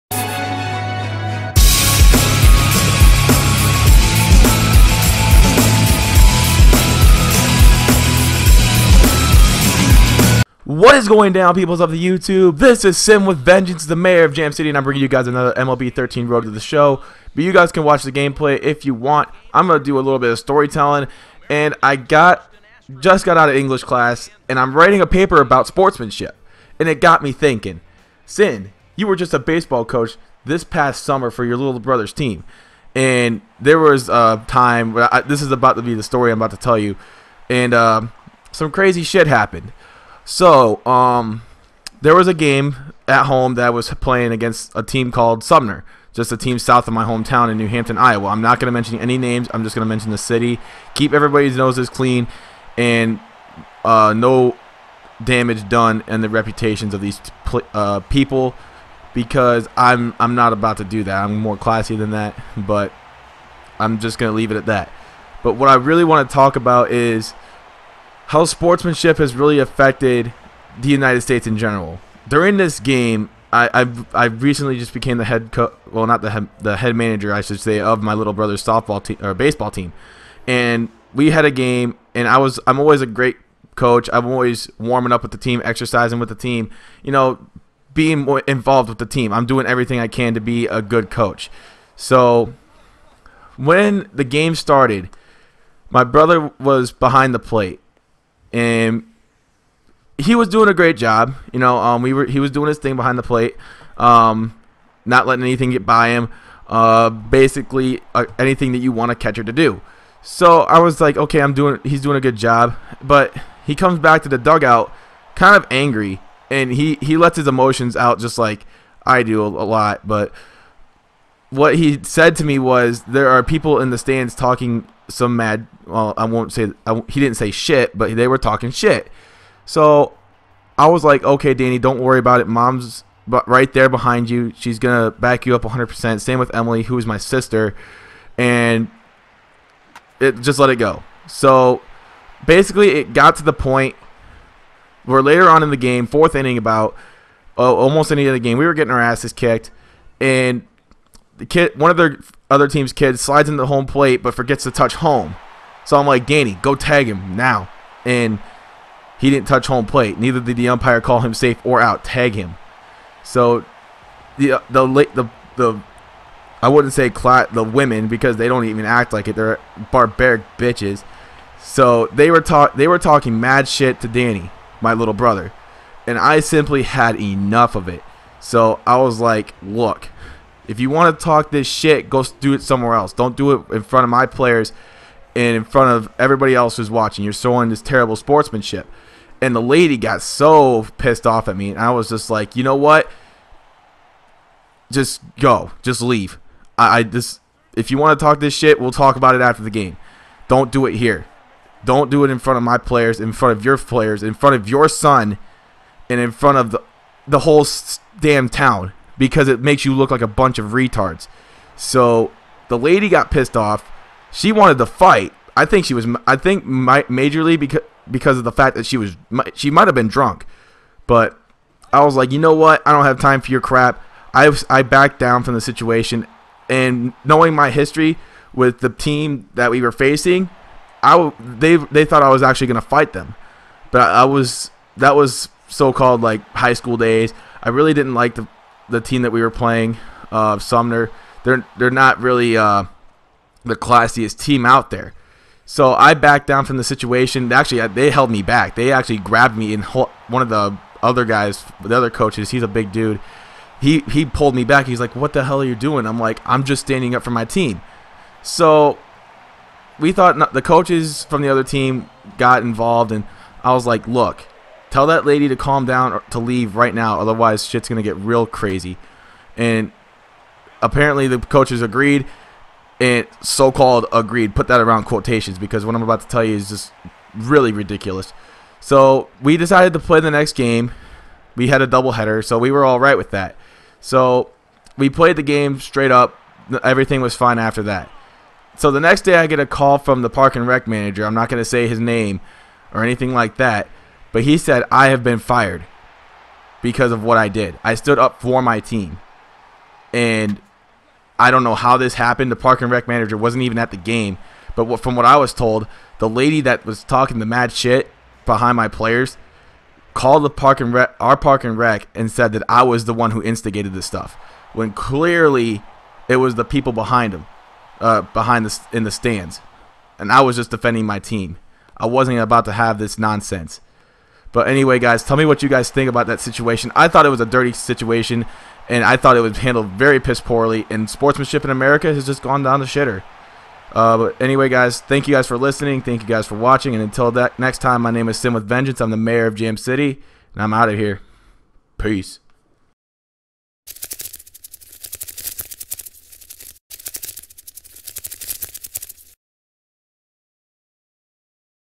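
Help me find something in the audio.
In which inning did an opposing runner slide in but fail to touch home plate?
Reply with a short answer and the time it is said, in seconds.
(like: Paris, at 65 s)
Fourth, at 146 s.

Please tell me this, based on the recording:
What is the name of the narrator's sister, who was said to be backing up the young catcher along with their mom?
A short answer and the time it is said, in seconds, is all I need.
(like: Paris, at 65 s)
Emily, at 136 s.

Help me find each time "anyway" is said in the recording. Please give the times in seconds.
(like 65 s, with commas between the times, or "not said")
324 s, 334 s.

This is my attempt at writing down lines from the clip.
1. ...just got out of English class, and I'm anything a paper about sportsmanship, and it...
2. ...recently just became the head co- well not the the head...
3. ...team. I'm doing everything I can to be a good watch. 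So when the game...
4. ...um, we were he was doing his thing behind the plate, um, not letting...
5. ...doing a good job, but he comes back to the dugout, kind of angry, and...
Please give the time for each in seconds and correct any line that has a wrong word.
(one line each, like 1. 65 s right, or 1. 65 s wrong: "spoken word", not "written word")
1. 22 s wrong: "writing", not "anything"
2. 74 s right
3. 89 s wrong: "coach", not "watch"
4. 101 s right
5. 112 s right.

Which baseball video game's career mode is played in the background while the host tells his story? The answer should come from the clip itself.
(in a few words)
MLB 13.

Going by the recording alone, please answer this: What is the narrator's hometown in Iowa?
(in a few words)
New Hampton.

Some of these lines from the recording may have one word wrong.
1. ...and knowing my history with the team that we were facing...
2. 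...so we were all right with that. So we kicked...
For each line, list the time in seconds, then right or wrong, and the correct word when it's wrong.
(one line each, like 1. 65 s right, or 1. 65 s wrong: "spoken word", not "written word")
1. 226 s right
2. 282 s wrong: "played", not "kicked".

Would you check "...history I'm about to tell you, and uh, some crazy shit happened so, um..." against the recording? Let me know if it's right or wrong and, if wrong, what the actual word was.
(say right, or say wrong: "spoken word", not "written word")
wrong: "story", not "history".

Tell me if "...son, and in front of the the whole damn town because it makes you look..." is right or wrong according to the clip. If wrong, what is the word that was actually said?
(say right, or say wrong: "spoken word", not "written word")
right.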